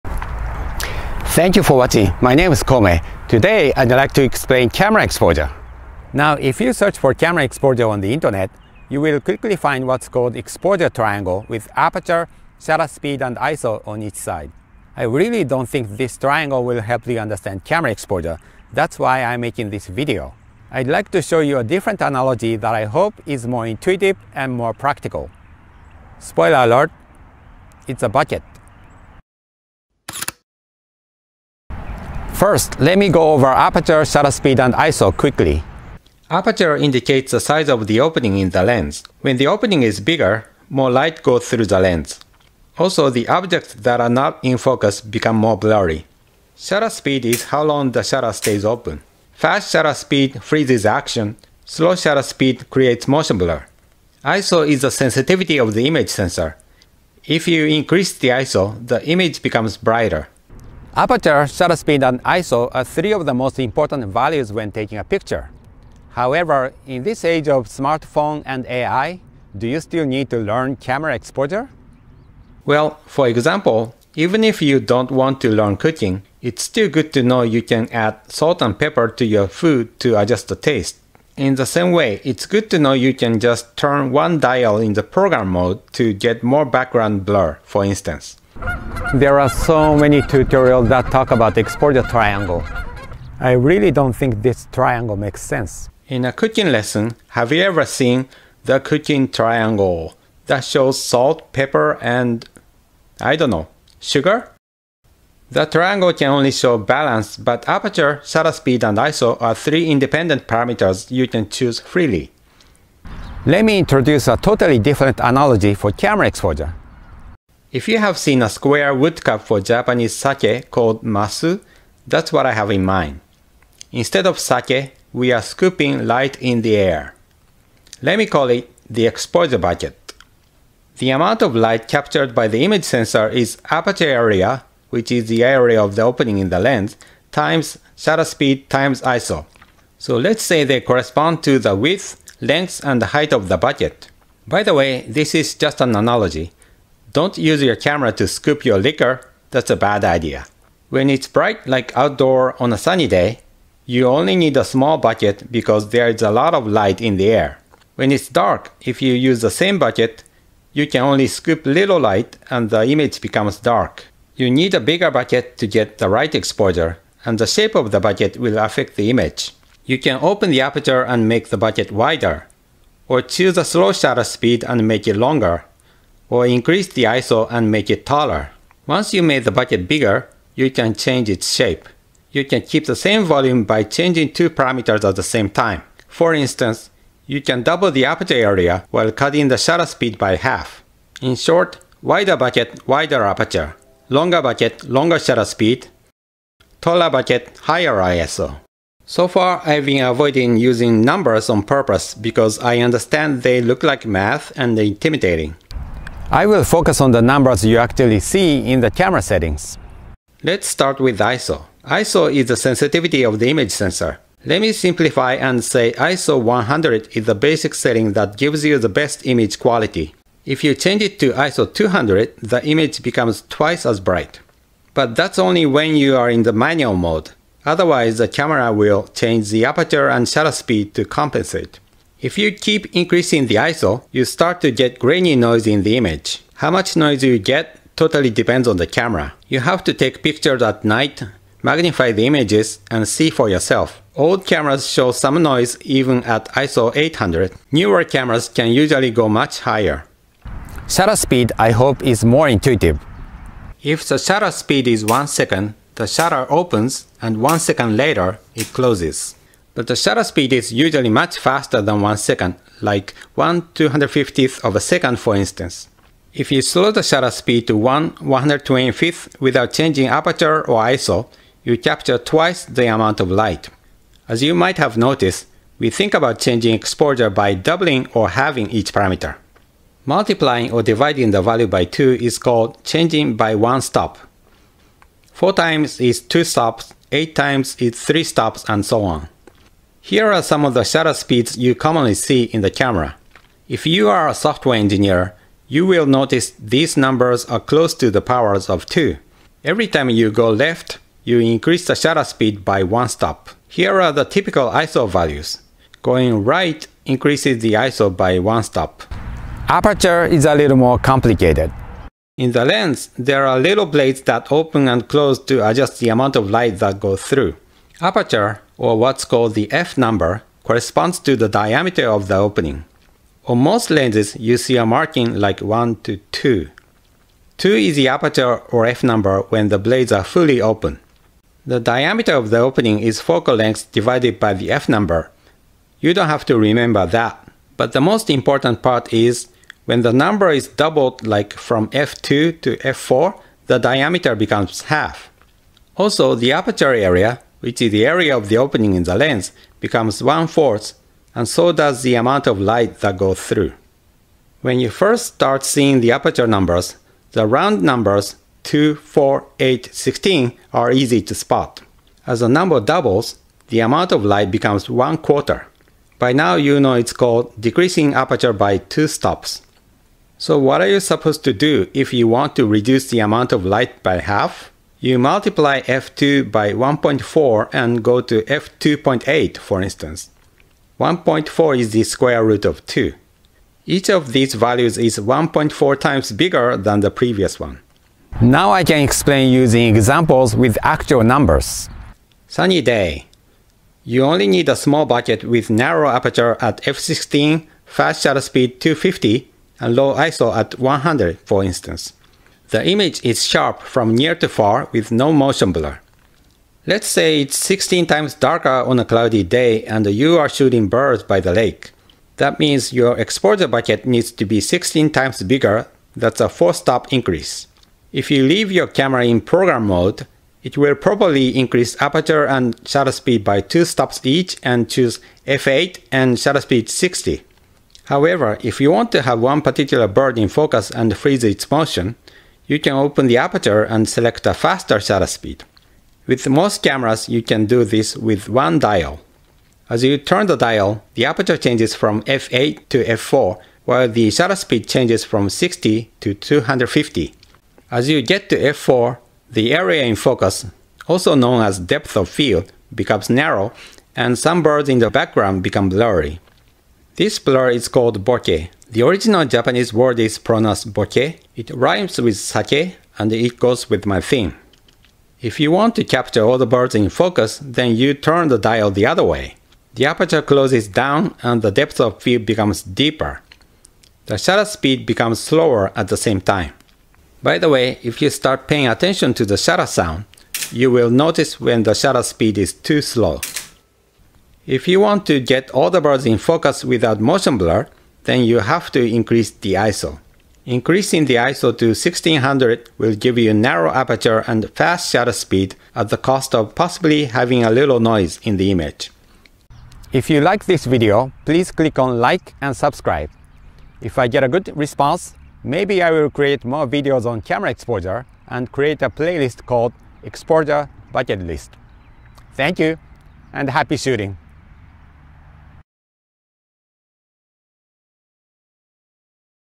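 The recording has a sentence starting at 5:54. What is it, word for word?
When you first start seeing the aperture numbers, the round numbers 2, 4, 8, 16 are easy to spot.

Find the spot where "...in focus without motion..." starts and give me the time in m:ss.
8:06.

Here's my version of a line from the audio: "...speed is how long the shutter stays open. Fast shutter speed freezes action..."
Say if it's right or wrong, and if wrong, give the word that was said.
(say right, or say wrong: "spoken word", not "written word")
right.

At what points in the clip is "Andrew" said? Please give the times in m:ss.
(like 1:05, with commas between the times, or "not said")
not said.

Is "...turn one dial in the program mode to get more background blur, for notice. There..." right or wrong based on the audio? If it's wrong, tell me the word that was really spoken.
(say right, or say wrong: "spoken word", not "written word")
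wrong: "instance", not "notice".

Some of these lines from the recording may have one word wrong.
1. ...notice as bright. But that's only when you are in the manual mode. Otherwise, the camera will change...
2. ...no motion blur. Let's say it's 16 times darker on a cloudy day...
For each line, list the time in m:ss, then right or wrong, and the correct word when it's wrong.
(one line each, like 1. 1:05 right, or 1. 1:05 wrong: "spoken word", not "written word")
1. 3:43 wrong: "twice", not "notice"
2. 6:45 right.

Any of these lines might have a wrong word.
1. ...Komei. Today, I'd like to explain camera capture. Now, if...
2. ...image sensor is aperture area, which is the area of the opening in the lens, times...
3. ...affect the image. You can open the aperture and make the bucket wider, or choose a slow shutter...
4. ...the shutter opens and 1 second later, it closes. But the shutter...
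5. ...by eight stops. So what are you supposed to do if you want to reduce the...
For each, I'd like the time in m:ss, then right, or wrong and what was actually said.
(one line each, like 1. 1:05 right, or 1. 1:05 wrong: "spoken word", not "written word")
1. 0:02 wrong: "exposure", not "capture"
2. 2:12 right
3. 2:48 right
4. 4:15 right
5. 6:08 wrong: "two", not "eight".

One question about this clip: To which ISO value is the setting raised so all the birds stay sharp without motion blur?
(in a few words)
1600.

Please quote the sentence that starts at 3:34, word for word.
Let me simplify and say ISO 100 is the basic setting that gives you the best image quality.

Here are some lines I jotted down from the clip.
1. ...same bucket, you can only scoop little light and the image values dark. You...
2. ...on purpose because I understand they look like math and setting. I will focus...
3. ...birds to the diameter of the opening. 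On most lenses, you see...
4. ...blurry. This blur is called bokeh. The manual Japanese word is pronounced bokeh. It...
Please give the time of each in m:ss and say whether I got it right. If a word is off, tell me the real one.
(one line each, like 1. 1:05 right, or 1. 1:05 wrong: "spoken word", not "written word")
1. 2:39 wrong: "becomes", not "values"
2. 3:21 wrong: "intimidating", not "setting"
3. 5:20 wrong: "corresponds", not "birds"
4. 7:35 wrong: "original", not "manual".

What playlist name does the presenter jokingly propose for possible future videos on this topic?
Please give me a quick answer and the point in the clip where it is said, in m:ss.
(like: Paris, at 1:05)
Exposure Bucket List, at 8:30.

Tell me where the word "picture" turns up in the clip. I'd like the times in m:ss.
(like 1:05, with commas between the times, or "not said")
1:05, 4:00.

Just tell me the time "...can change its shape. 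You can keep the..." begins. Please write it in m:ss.
3:00.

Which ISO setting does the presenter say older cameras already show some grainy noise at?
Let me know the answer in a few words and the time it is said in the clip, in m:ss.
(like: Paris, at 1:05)
ISO 800, at 4:06.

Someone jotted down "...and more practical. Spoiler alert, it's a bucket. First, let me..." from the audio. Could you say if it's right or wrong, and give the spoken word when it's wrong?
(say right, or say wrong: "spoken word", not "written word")
right.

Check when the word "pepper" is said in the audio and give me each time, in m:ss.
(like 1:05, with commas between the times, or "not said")
1:18, 1:41.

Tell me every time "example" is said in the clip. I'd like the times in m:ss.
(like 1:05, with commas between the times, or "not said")
1:13, 6:29.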